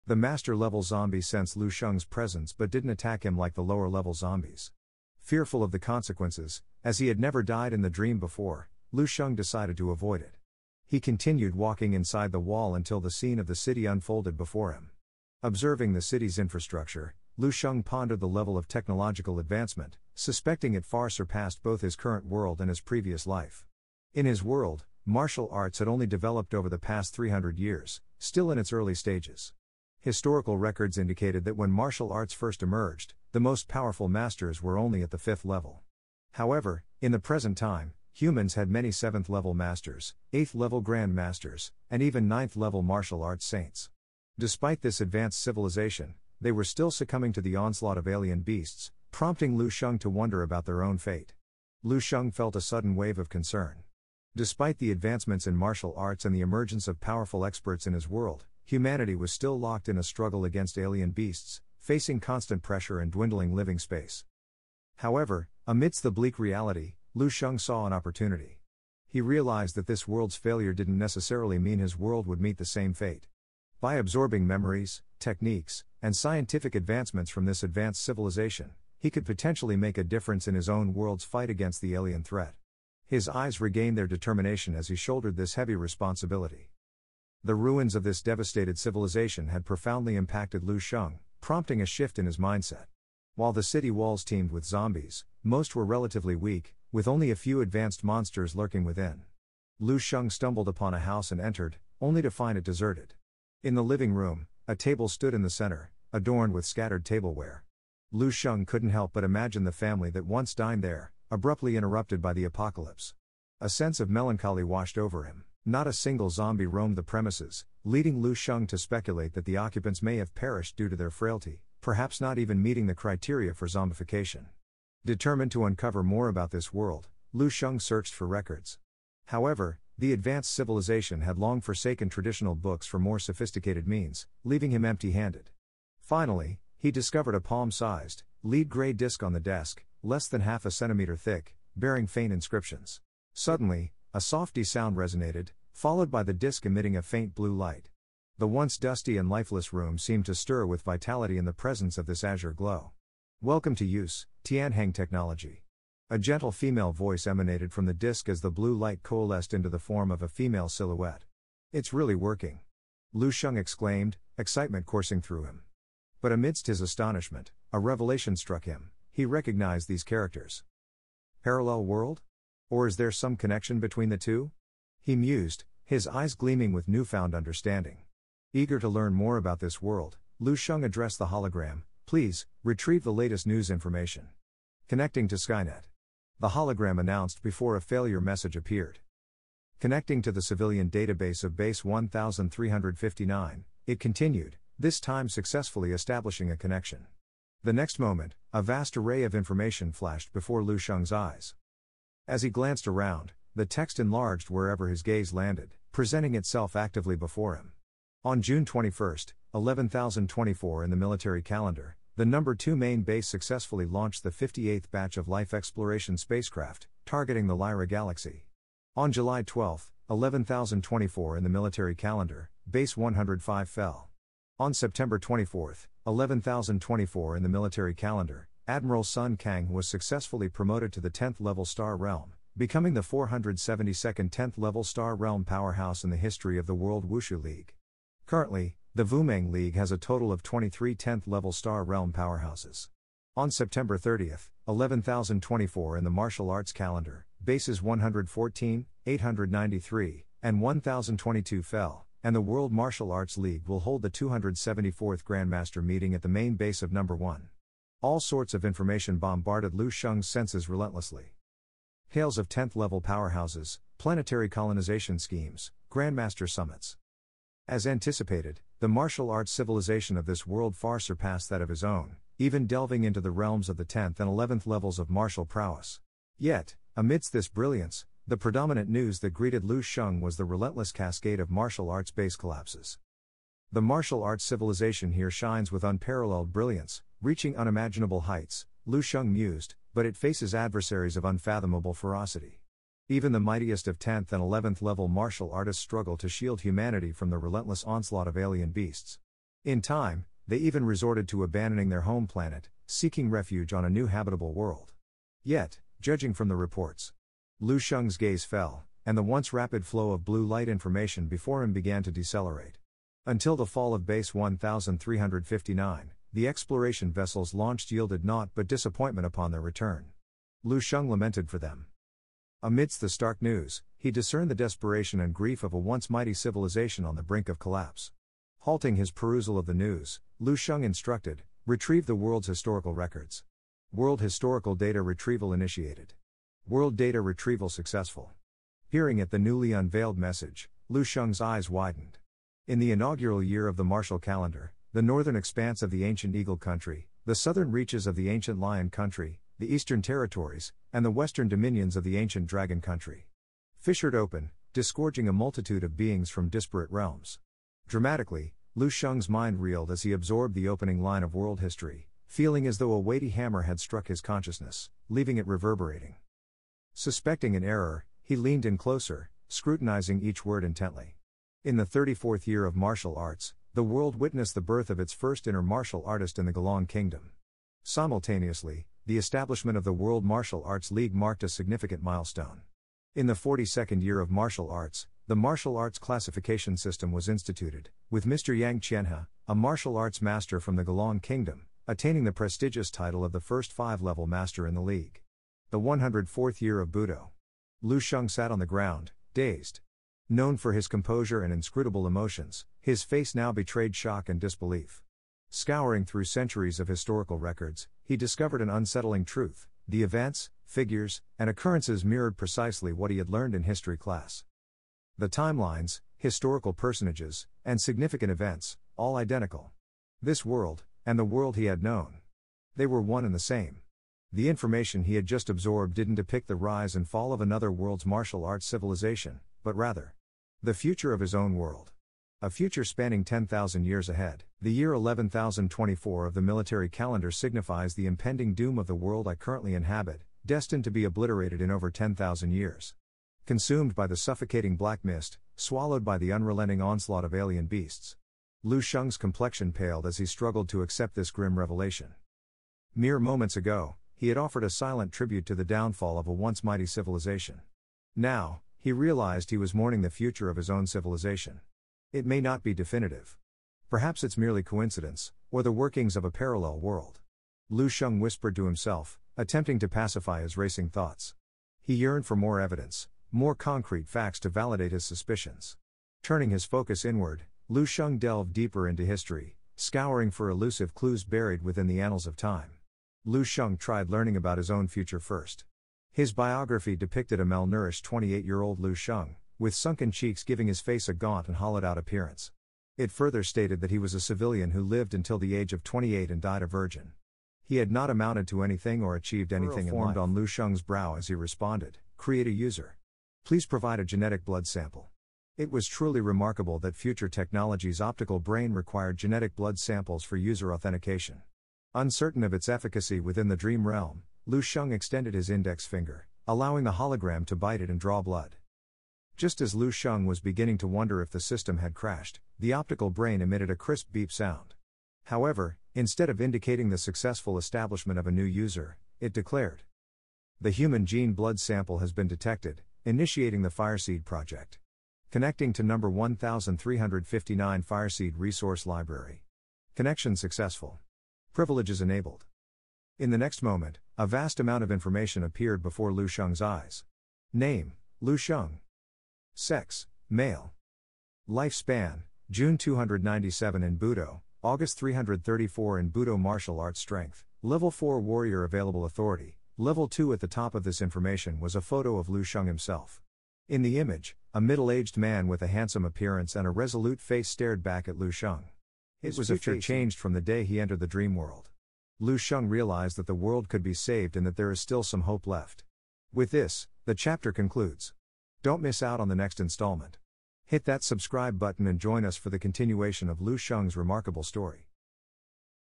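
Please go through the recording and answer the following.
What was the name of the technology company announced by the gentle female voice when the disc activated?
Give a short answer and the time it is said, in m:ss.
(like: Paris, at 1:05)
Tianhang technology, at 2:34.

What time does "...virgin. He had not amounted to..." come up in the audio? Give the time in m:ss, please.
8:16.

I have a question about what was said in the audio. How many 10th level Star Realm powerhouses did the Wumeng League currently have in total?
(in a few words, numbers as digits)
23.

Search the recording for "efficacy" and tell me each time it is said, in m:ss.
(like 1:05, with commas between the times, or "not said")
8:32.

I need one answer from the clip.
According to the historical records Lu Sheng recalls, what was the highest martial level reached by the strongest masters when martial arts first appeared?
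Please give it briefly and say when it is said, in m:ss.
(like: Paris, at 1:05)
fifth level, at 0:35.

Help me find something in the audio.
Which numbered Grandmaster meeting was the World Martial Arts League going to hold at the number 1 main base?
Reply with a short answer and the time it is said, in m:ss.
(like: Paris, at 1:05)
274th, at 4:14.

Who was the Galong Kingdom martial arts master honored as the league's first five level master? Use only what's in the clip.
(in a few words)
Yang Qianhe.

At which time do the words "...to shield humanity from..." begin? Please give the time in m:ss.
4:56.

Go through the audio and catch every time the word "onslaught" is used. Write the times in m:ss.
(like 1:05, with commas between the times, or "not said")
0:47, 4:57, 7:26.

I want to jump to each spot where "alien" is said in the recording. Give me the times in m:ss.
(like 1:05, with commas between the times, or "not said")
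0:48, 1:00, 1:21, 4:58, 7:27.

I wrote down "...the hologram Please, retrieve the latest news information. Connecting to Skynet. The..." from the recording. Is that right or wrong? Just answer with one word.
right.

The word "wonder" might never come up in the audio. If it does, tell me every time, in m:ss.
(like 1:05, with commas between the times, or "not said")
0:50, 8:40.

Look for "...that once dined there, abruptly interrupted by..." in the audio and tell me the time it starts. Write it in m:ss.
1:50.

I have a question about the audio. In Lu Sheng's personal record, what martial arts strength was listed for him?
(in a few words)
Level 4 Warrior.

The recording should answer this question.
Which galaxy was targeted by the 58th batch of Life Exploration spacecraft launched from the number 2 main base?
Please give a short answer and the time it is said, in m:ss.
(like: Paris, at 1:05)
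Lyra galaxy, at 3:37.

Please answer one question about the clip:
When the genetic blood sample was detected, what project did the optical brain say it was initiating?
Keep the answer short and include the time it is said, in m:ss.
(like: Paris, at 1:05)
Fireseed project, at 8:53.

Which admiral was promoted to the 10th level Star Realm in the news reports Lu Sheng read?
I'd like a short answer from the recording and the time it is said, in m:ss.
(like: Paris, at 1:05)
Sun Kang, at 3:48.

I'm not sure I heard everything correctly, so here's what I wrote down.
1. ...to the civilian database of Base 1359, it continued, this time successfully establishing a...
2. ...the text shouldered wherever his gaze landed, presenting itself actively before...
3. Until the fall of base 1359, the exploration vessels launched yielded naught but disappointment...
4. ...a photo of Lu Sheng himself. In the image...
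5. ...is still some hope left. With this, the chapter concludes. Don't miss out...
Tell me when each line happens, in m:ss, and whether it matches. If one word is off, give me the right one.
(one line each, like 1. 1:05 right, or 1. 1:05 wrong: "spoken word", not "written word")
1. 3:10 right
2. 3:23 wrong: "enlarged", not "shouldered"
3. 5:13 right
4. 9:21 right
5. 9:34 right.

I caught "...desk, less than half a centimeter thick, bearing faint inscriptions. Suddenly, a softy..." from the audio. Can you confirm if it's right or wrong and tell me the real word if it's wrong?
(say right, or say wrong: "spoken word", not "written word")
right.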